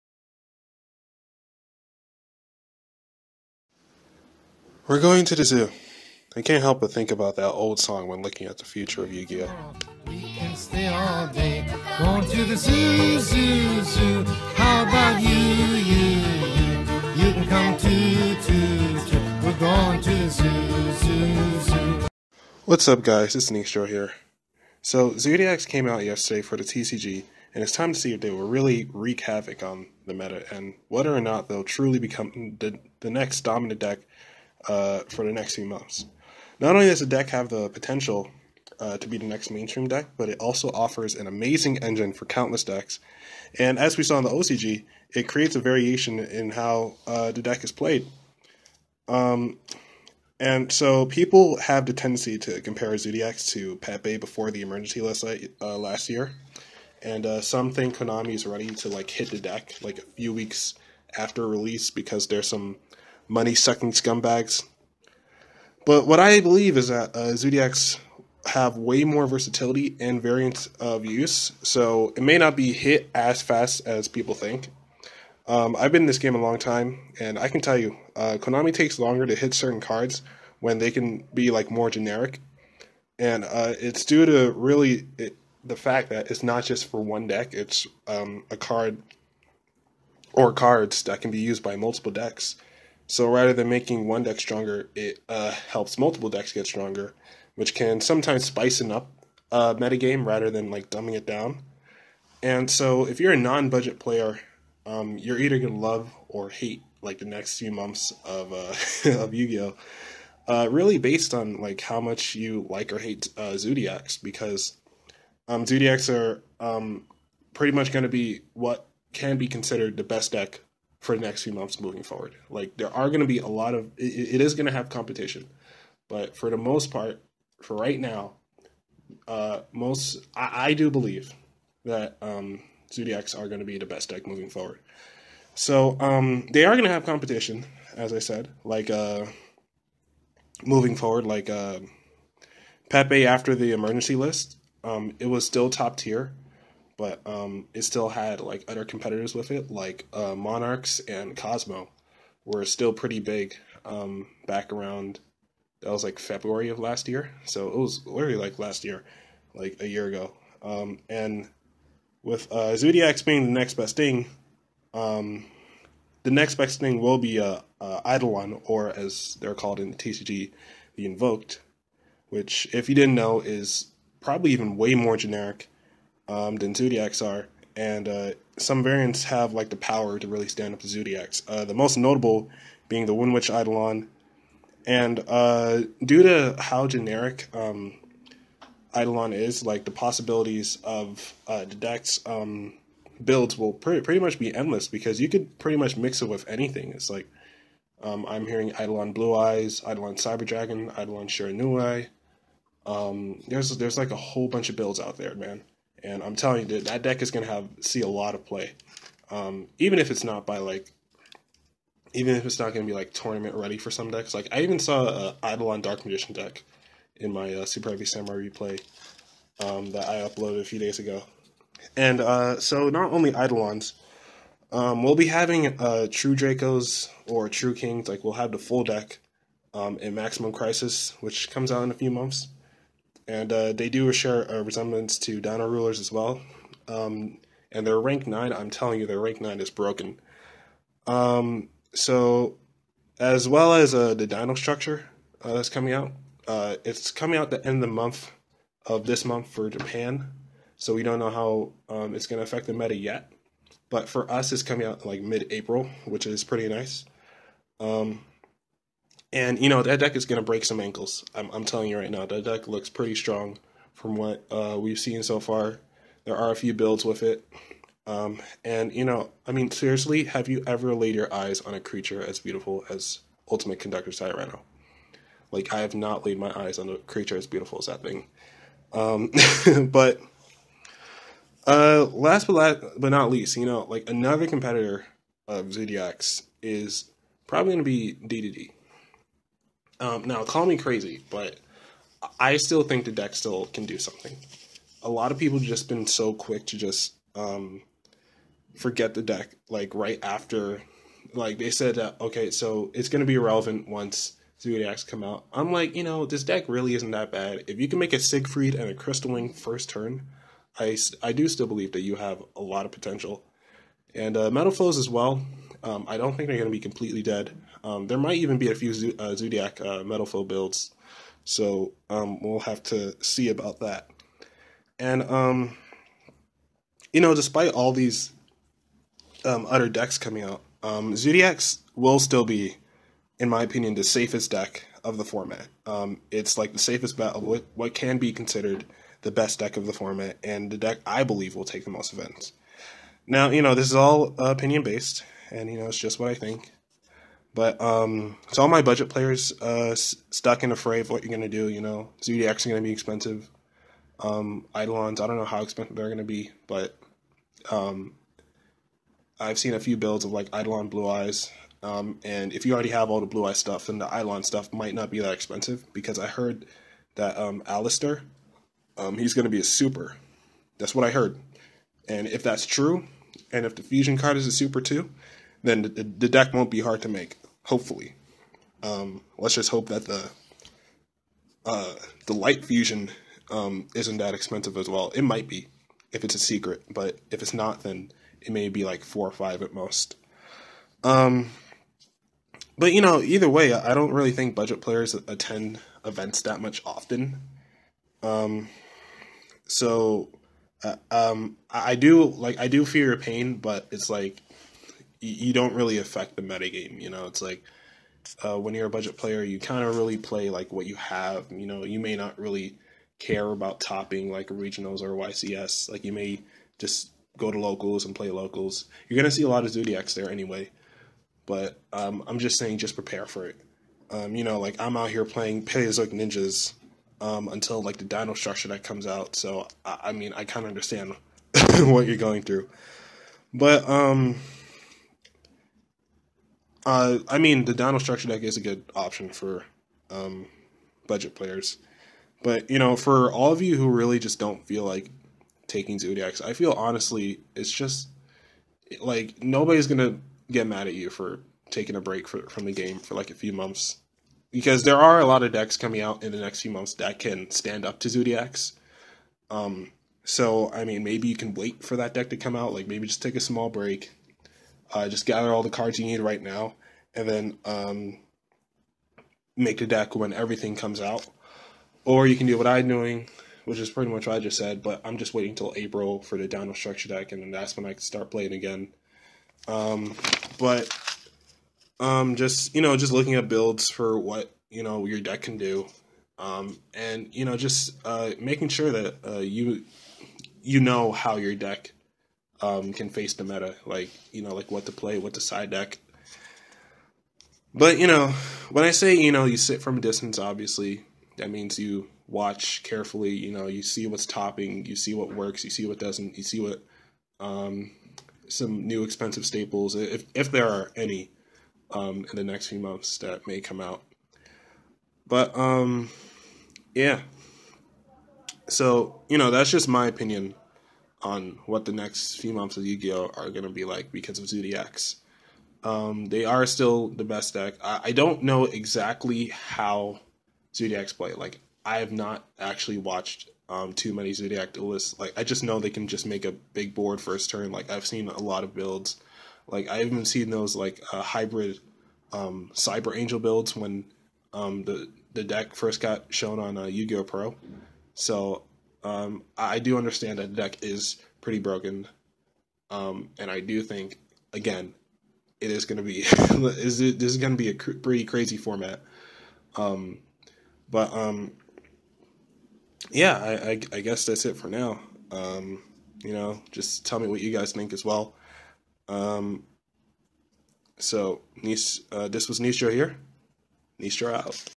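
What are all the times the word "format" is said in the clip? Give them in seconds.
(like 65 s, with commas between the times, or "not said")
335 s, 339 s, 558 s.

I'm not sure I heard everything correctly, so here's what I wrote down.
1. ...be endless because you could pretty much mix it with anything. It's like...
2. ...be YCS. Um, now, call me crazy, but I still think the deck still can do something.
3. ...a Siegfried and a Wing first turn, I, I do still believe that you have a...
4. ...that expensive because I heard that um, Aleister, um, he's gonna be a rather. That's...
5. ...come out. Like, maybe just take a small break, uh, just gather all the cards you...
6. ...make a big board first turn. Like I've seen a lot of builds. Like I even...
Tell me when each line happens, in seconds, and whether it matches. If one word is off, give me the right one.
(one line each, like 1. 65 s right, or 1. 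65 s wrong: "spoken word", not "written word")
1. 194 s right
2. 287 s wrong: "DDD", not "YCS"
3. 308 s right
4. 365 s wrong: "super", not "rather"
5. 462 s right
6. 536 s right.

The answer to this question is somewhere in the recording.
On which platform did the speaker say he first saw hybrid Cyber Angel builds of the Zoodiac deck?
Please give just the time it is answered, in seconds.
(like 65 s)
546 s.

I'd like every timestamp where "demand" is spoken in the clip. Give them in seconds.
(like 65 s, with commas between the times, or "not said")
not said.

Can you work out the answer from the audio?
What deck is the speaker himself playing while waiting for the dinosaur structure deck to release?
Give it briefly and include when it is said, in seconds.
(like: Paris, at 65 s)
Paleozoic Ninjas, at 425 s.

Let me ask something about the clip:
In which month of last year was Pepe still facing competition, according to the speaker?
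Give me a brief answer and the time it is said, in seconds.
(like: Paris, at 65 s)
February, at 156 s.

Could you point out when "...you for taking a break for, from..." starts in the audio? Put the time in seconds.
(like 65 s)
450 s.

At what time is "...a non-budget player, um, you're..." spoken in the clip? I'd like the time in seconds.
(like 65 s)
103 s.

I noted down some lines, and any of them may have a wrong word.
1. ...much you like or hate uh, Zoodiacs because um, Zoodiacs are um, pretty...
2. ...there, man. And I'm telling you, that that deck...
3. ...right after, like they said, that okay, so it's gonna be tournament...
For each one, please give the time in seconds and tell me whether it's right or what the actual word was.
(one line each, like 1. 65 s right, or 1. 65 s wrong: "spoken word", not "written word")
1. 111 s right
2. 205 s right
3. 299 s wrong: "irrelevant", not "tournament".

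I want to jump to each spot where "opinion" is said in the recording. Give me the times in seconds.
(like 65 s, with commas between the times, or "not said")
333 s, 344 s, 520 s.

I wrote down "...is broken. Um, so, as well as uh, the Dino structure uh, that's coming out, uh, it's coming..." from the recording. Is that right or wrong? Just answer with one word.
right.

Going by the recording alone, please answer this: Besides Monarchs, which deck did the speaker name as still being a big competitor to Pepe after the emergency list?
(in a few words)
Kozmo.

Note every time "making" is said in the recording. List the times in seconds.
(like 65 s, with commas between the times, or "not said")
93 s, 488 s.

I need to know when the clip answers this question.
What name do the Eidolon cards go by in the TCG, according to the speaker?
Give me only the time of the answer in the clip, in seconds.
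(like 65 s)
170 s.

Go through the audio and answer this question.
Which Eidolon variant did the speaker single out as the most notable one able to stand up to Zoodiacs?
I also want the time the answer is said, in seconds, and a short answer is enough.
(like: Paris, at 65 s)
Wind Witch Eidolon, at 183 s.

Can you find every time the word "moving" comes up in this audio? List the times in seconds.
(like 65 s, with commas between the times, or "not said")
121 s, 134 s, 140 s.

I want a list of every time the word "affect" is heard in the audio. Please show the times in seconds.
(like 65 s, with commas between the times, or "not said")
252 s, 405 s.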